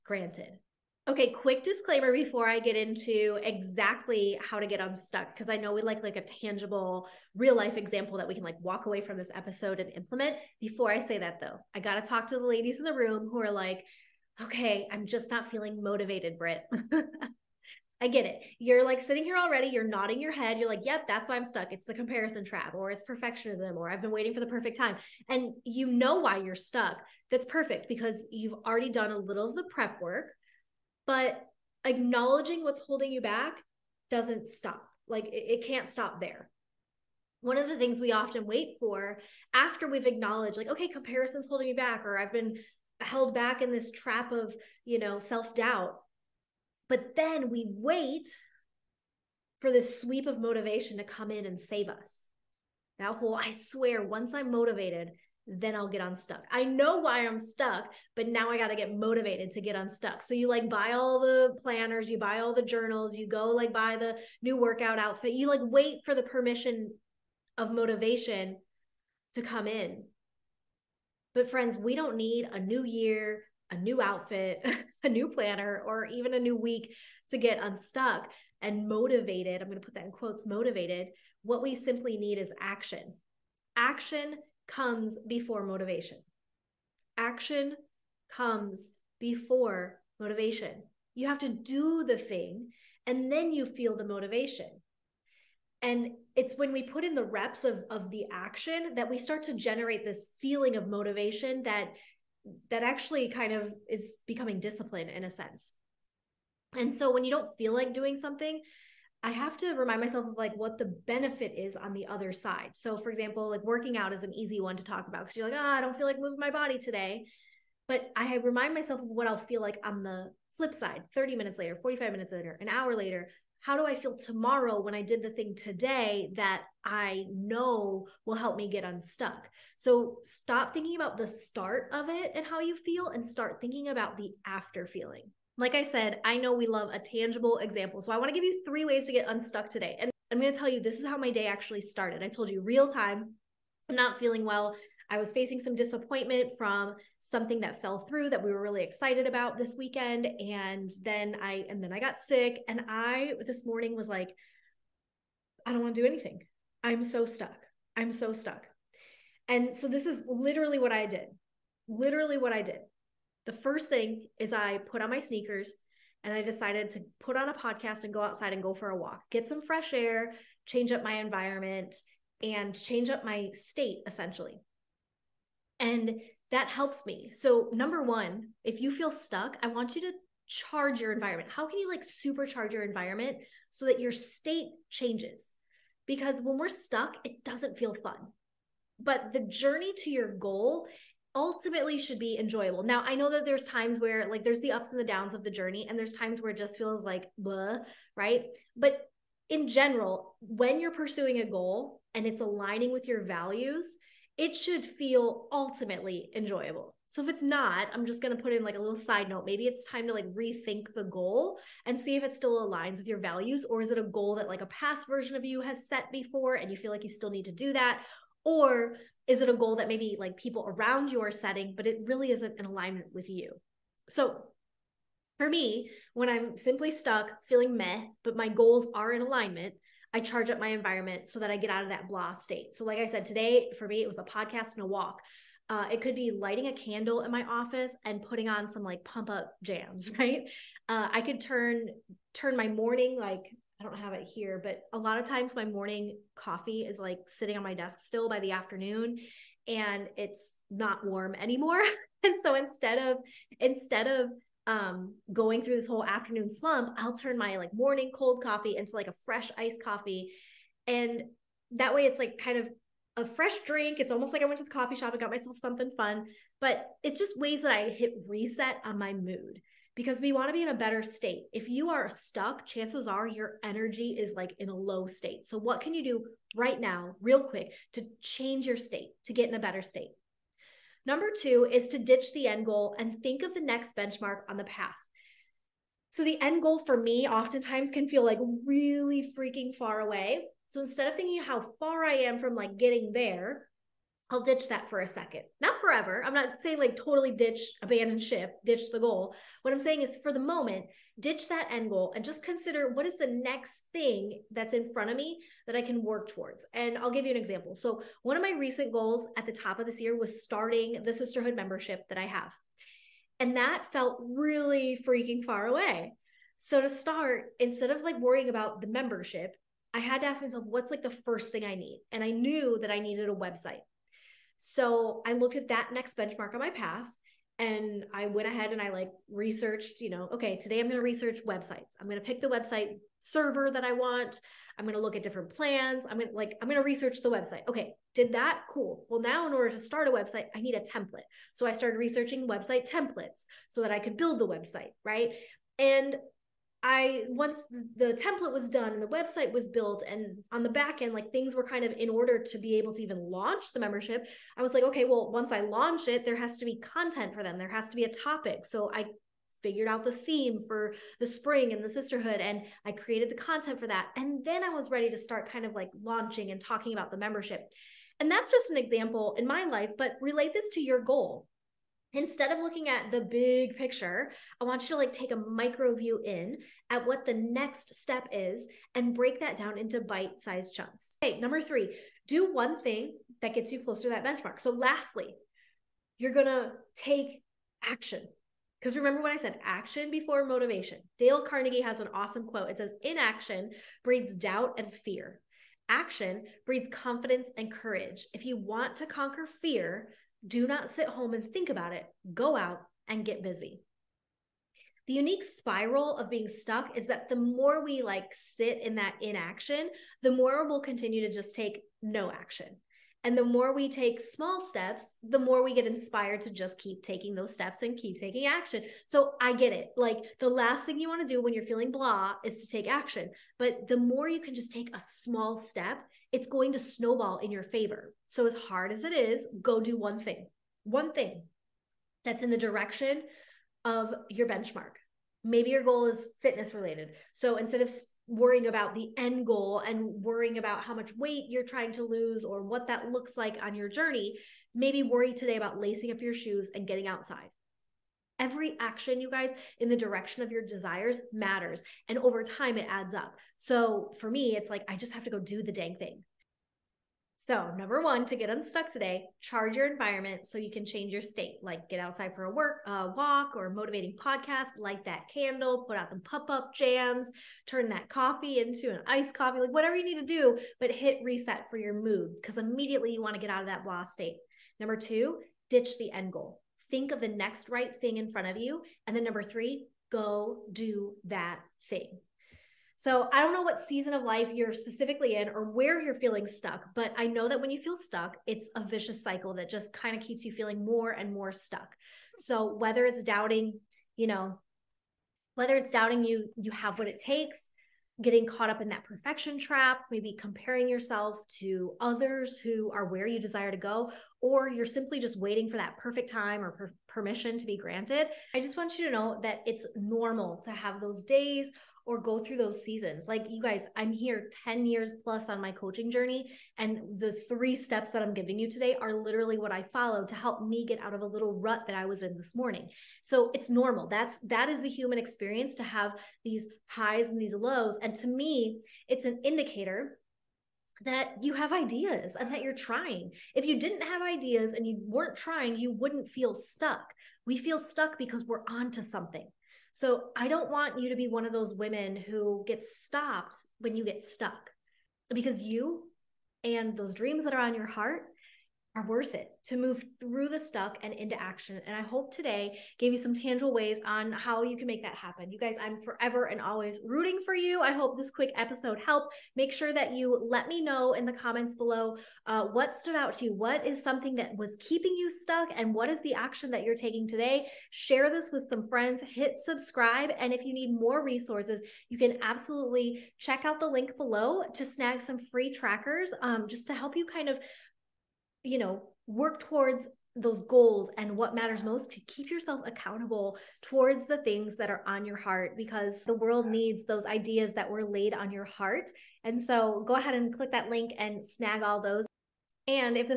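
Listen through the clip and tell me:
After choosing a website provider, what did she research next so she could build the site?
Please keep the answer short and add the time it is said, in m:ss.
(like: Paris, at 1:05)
Website templates, at 5:42.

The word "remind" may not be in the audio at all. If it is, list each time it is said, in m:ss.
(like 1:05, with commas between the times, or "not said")
1:49, 1:58.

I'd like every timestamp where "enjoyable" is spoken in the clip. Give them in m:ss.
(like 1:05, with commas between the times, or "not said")
3:12, 3:26.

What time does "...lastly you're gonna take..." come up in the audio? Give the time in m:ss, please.
6:24.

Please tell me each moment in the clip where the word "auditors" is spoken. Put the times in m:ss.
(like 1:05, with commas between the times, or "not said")
not said.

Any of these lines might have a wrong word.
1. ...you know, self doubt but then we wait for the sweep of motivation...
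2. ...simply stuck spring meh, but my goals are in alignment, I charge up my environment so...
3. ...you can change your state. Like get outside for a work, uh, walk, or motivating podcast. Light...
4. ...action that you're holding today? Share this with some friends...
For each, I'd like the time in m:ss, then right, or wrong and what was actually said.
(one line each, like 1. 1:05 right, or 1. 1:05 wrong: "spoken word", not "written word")
1. 0:44 right
2. 3:46 wrong: "feeling", not "spring"
3. 7:40 right
4. 9:26 wrong: "taking", not "holding".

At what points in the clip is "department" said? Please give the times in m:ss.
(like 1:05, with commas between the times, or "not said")
not said.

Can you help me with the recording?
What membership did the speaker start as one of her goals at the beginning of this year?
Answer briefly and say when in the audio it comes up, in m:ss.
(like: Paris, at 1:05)
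The sisterhood membership, at 5:11.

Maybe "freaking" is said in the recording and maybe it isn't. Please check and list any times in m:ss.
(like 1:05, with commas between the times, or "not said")
4:49, 5:15.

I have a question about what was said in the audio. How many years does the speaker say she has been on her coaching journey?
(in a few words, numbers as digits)
10 years plus.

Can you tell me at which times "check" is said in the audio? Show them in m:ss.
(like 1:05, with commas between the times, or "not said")
9:33.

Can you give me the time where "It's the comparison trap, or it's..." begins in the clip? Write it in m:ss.
0:21.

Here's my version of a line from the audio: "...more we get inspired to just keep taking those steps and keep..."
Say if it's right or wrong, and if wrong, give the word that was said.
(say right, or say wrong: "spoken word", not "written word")
right.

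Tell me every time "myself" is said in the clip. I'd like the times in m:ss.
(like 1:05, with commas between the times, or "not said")
1:50, 1:58, 4:25, 5:20.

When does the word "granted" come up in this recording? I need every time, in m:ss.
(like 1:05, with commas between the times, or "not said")
0:00, 8:27.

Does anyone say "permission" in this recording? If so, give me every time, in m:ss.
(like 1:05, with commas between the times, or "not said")
1:06, 8:27.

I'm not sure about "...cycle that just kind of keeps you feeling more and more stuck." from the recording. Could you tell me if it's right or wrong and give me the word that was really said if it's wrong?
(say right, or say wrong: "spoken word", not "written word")
right.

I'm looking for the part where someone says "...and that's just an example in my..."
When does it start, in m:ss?
6:08.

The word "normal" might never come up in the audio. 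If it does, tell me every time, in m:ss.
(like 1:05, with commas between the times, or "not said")
8:29, 8:43.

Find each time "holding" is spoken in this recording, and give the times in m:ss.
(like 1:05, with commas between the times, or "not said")
0:32, 0:41.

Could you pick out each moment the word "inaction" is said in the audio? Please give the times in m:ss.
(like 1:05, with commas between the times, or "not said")
6:33, 6:49.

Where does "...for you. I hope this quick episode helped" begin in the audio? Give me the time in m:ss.
9:17.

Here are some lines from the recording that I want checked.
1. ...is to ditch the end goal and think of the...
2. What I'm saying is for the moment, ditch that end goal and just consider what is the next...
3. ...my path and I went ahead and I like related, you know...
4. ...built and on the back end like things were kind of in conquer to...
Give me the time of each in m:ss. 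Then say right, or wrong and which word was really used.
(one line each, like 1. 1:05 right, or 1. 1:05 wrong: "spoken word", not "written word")
1. 4:41 right
2. 4:59 right
3. 5:26 wrong: "researched", not "related"
4. 5:49 wrong: "order", not "conquer".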